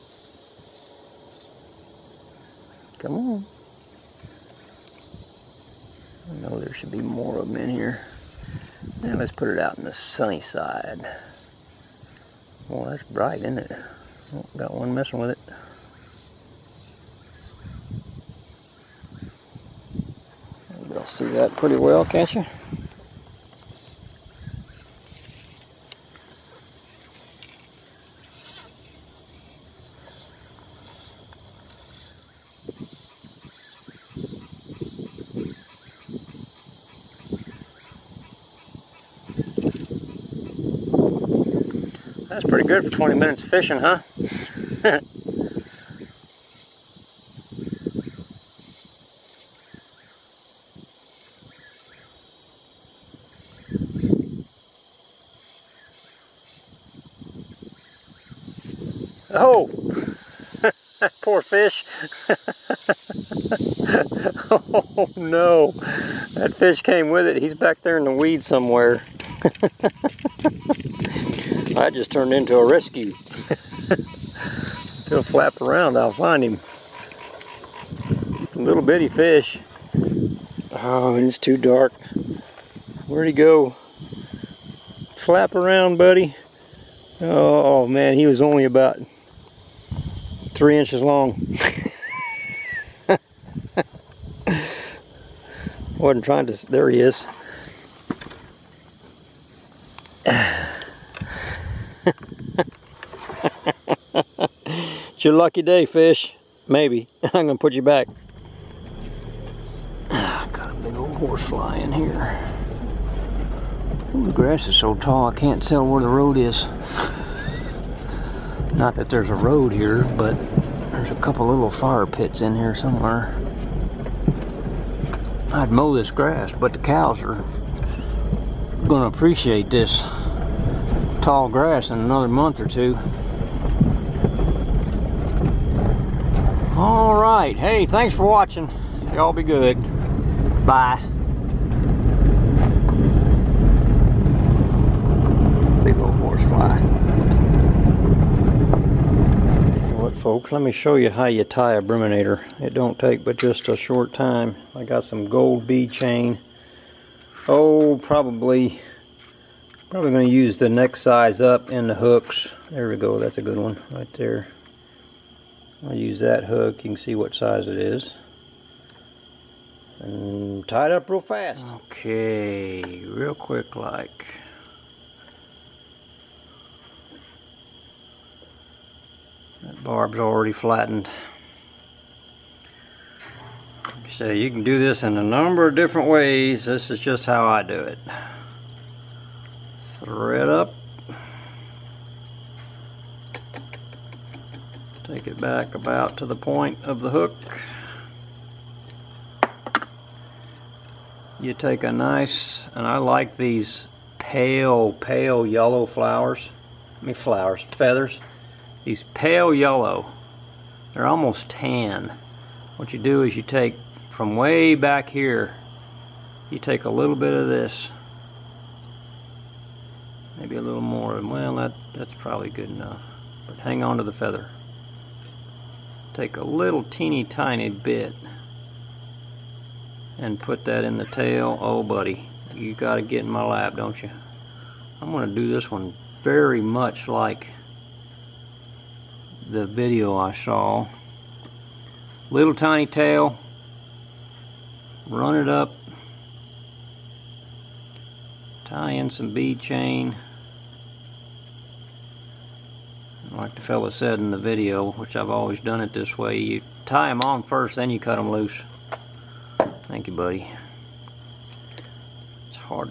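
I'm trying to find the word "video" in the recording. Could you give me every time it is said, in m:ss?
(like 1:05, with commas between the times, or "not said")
3:59, 4:14.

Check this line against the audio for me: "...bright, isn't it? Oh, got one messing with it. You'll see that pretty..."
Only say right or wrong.
right.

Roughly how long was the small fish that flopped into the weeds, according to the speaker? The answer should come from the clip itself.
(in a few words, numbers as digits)
3 inches.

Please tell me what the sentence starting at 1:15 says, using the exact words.
He'll flap around, I'll find him.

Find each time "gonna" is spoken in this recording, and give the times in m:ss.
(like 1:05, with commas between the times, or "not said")
1:47, 2:08.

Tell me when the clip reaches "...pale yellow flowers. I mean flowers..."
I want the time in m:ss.
3:24.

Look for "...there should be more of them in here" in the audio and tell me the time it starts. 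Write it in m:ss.
0:06.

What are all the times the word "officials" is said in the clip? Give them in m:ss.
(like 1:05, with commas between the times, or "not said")
not said.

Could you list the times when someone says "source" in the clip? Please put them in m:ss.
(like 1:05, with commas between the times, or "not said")
not said.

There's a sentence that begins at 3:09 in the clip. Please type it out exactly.
Thread up take it back about to the point of the hook.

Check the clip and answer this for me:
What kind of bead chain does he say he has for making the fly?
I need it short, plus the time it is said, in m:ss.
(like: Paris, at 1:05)
gold, at 2:35.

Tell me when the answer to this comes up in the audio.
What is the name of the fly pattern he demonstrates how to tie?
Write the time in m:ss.
2:31.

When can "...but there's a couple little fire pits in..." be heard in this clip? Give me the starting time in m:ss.
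2:00.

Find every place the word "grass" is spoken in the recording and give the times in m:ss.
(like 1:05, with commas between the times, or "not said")
1:54, 2:06, 2:11.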